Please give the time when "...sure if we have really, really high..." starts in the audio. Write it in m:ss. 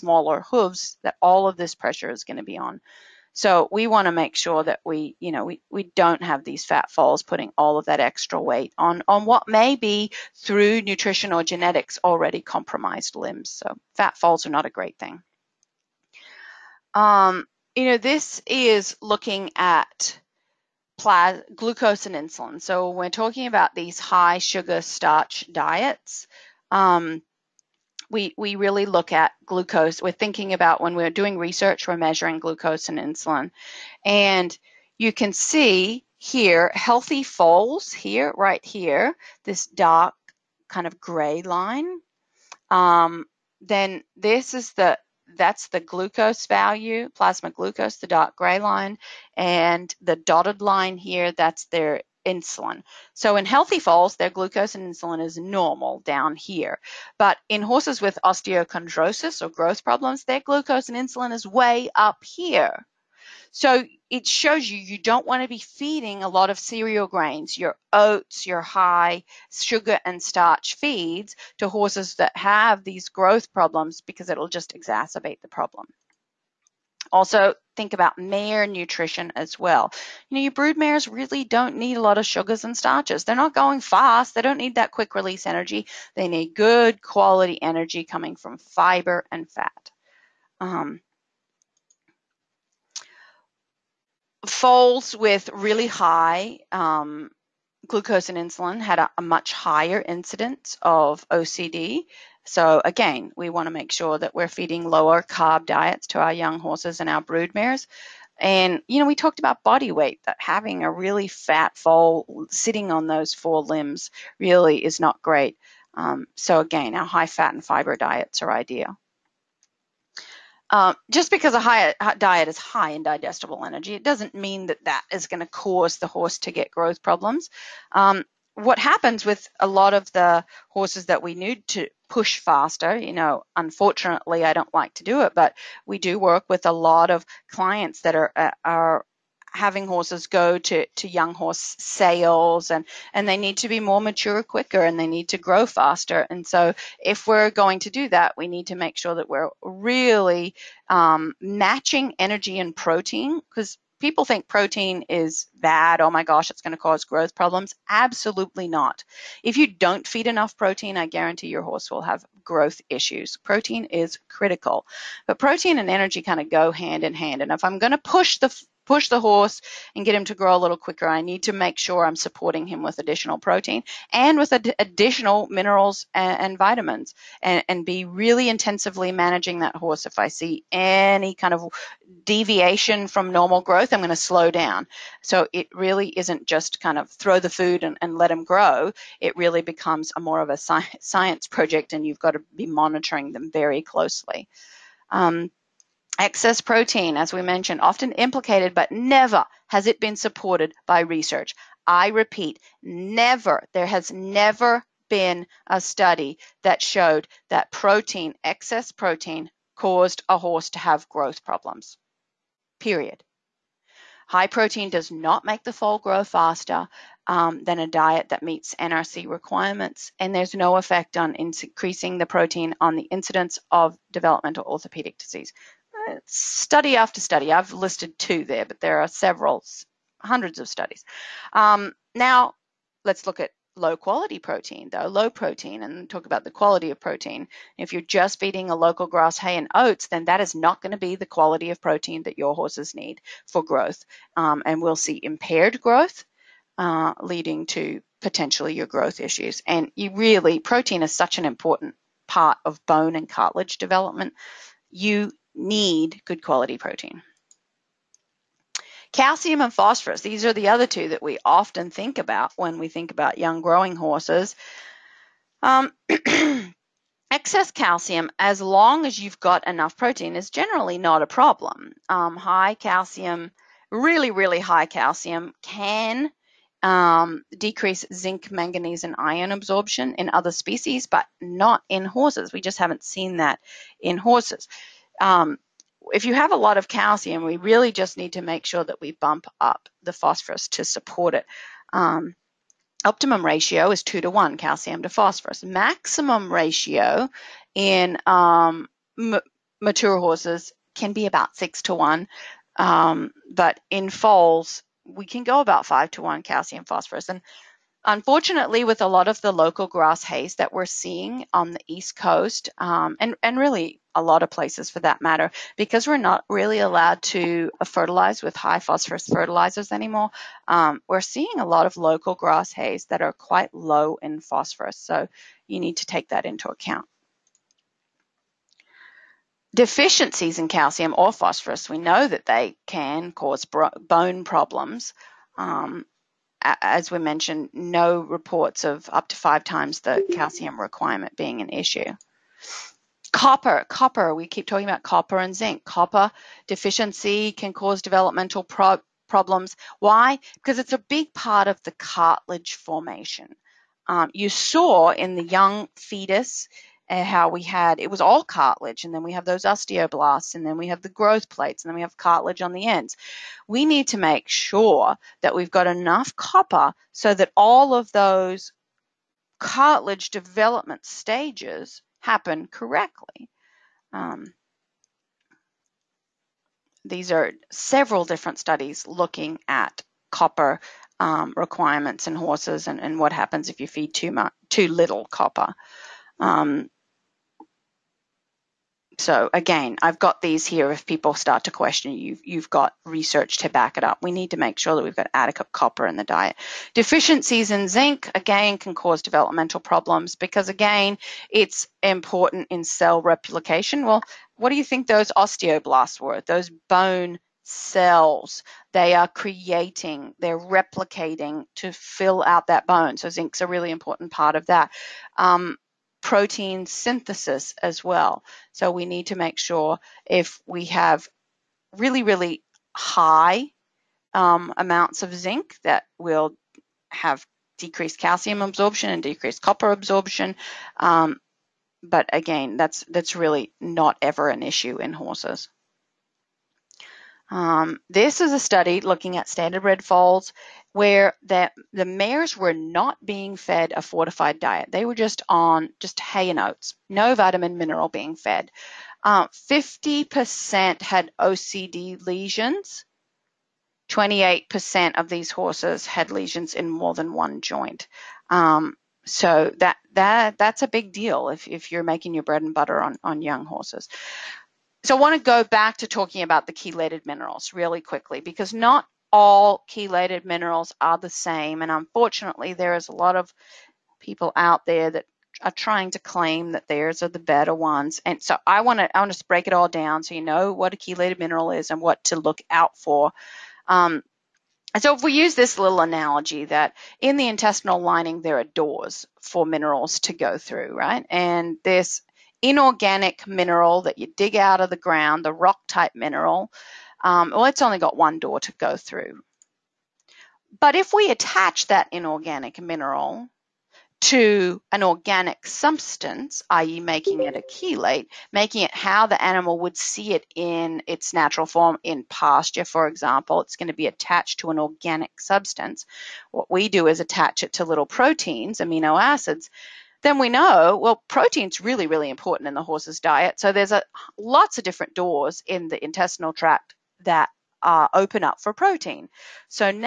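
6:59.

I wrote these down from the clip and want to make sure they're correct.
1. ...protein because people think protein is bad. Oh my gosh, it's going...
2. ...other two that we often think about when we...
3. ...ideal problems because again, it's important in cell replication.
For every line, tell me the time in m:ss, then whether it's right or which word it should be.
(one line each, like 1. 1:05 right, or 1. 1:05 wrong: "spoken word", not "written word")
1. 2:32 right
2. 4:20 right
3. 6:39 wrong: "developmental", not "ideal".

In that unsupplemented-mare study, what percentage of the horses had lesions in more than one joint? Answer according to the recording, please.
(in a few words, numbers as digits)
28%.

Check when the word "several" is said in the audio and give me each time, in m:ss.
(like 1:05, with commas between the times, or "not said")
3:49, 6:17.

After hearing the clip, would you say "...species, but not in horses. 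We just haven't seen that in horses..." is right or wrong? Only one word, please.
right.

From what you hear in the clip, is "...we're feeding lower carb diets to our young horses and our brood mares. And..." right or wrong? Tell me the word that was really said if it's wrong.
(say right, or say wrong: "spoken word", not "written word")
right.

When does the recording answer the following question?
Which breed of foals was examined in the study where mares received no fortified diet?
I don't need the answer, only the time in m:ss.
7:19.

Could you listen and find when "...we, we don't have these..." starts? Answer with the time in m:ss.
0:05.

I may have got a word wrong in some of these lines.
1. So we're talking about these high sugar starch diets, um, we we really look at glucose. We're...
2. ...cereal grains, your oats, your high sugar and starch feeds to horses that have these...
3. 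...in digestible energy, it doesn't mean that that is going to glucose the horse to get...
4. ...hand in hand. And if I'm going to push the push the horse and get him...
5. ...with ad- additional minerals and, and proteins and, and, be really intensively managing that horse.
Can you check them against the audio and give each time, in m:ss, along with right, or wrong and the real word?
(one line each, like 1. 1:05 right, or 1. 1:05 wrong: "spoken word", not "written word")
1. 0:22 right
2. 1:06 right
3. 2:02 wrong: "cause", not "glucose"
4. 2:46 right
5. 2:54 wrong: "vitamins", not "proteins".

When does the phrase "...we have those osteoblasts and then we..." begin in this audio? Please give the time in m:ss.
5:59.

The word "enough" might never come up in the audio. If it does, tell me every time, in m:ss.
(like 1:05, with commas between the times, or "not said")
2:40, 4:29, 6:05.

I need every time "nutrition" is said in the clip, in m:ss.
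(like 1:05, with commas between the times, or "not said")
0:10, 1:18.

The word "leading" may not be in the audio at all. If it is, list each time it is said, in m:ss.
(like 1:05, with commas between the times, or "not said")
4:07.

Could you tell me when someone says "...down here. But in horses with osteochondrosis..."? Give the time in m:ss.
0:55.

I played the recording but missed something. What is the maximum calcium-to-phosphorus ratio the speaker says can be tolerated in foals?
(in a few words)
5 to 1.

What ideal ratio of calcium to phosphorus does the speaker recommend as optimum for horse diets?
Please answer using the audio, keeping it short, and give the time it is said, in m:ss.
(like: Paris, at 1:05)
2 to 1, at 4:54.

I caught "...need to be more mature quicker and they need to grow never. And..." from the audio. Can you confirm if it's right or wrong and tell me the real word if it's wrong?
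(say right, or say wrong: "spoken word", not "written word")
wrong: "faster", not "never".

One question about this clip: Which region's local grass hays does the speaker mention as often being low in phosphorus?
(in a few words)
East Coast.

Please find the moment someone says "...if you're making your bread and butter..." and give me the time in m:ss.
7:41.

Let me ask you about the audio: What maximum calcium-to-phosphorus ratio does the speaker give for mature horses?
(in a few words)
6 to 1.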